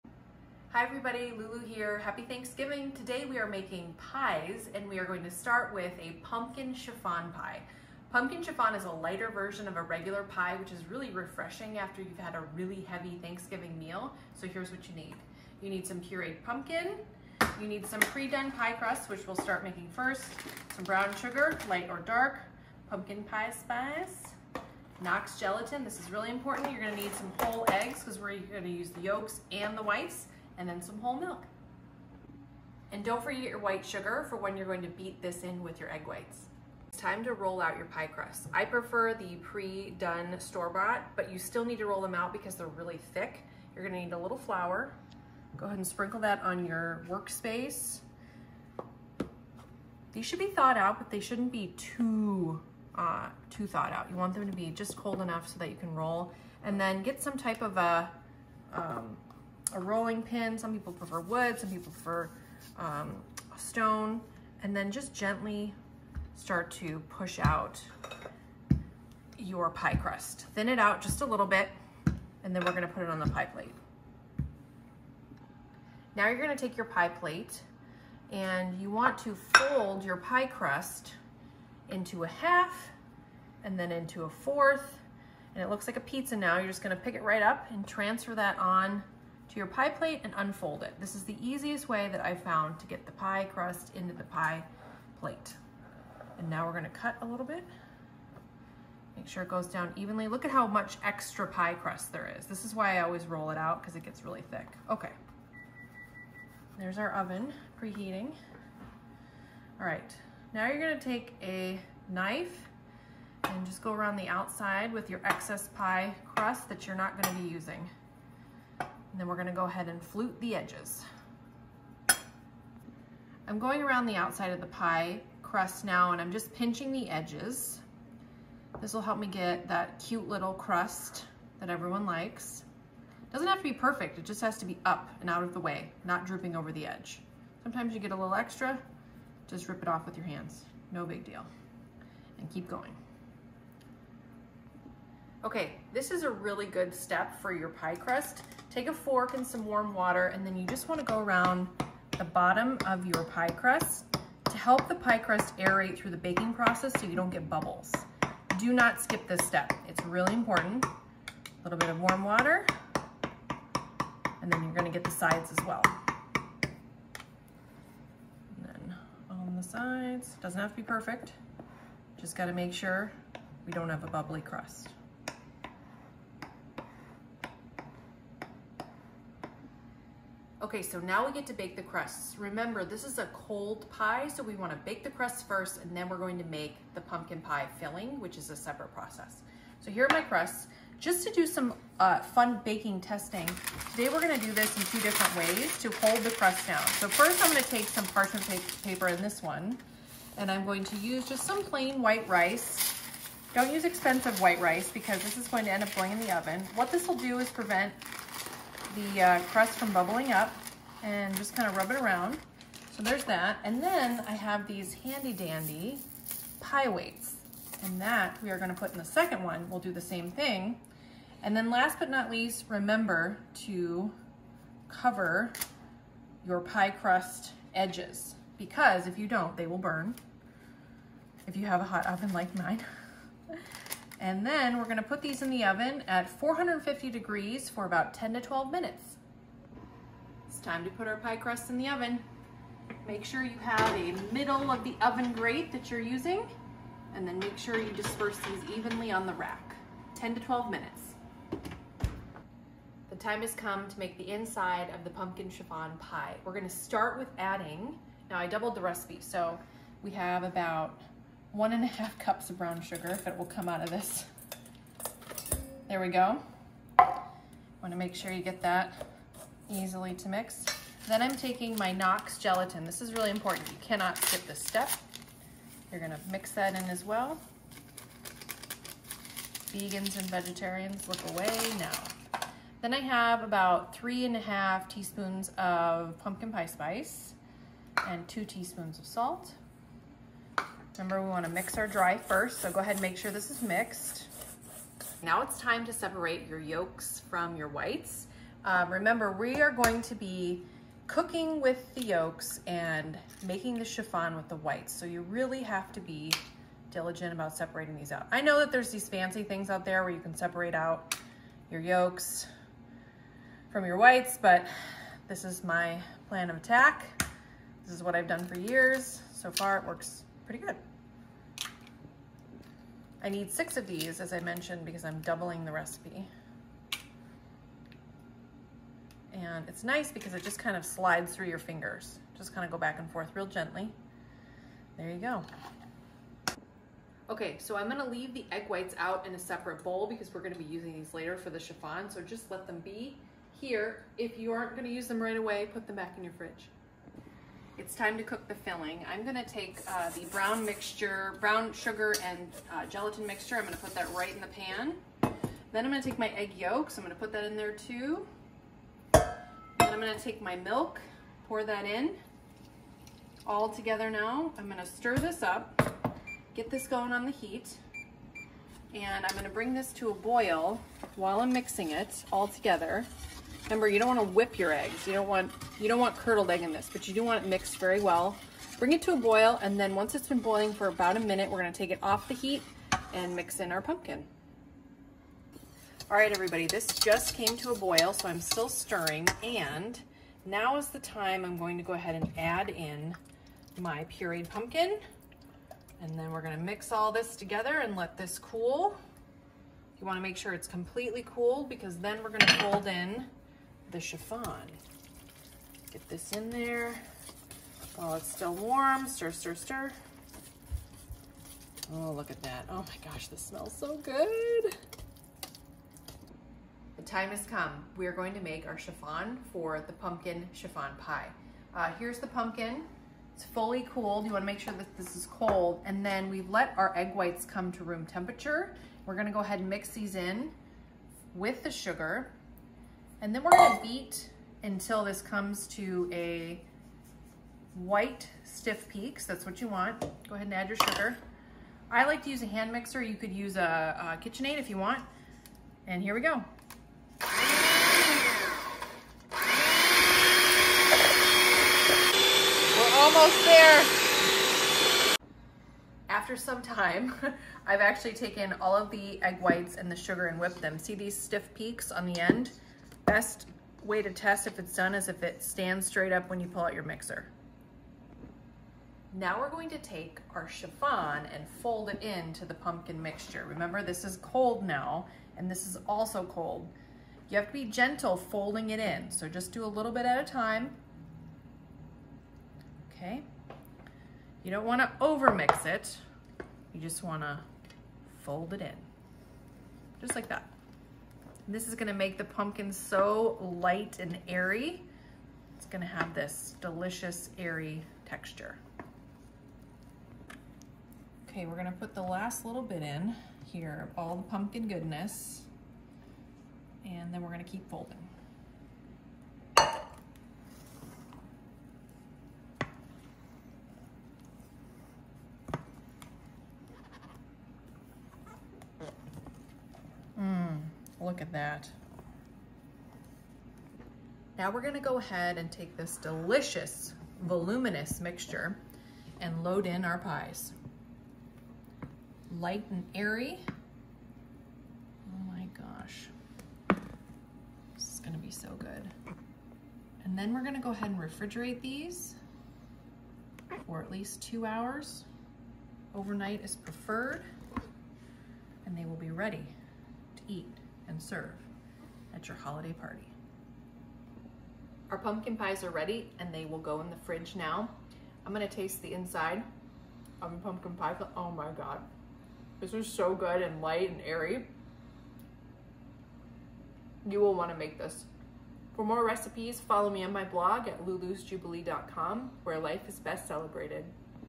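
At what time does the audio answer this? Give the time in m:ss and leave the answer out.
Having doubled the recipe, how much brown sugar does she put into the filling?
4:21.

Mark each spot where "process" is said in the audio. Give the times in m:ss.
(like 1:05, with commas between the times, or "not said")
2:36, 3:08.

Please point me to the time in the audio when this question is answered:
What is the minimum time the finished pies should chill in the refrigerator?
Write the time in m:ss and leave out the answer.
9:04.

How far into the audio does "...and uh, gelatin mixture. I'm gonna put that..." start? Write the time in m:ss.
5:52.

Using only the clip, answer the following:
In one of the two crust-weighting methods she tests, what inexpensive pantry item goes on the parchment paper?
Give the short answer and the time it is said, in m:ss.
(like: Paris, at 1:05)
plain white rice, at 3:21.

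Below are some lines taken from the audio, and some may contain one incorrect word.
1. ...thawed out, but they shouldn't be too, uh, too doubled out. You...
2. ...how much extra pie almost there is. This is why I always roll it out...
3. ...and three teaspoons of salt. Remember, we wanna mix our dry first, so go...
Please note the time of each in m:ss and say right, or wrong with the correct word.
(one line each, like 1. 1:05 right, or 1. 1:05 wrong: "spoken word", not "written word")
1. 0:50 wrong: "thawed", not "doubled"
2. 1:40 wrong: "crust", not "almost"
3. 4:48 wrong: "two", not "three".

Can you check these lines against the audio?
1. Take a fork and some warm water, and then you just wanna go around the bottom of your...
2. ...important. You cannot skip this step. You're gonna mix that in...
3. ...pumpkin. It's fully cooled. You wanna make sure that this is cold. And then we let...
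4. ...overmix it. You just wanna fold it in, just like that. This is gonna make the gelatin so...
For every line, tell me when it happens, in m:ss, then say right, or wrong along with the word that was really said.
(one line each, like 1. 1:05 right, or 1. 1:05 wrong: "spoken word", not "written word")
1. 2:28 right
2. 4:33 right
3. 7:02 right
4. 8:04 wrong: "pumpkin", not "gelatin".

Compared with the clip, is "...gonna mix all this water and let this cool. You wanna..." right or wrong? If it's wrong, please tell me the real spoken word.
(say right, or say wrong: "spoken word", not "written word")
wrong: "together", not "water".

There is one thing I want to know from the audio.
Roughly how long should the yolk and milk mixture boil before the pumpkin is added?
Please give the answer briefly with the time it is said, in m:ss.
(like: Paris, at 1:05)
about a minute, at 6:20.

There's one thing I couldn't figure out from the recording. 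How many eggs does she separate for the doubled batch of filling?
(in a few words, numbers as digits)
6.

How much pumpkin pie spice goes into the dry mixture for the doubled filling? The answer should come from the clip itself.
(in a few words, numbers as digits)
3 and a half teaspoons.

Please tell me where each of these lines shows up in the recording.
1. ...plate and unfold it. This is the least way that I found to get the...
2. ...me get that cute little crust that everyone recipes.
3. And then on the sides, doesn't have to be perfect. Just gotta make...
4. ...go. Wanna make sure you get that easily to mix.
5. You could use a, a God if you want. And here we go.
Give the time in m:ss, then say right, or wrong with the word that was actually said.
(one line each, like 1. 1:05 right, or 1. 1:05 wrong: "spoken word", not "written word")
1. 1:29 wrong: "easiest", not "least"
2. 2:09 wrong: "likes", not "recipes"
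3. 2:48 right
4. 4:26 right
5. 7:23 wrong: "KitchenAid", not "God".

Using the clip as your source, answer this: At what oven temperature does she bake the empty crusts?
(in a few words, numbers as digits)
450 degrees.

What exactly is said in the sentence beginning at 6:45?
Get this in there while it's still warm.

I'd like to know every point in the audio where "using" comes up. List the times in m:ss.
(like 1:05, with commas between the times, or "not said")
1:57, 4:05, 5:40.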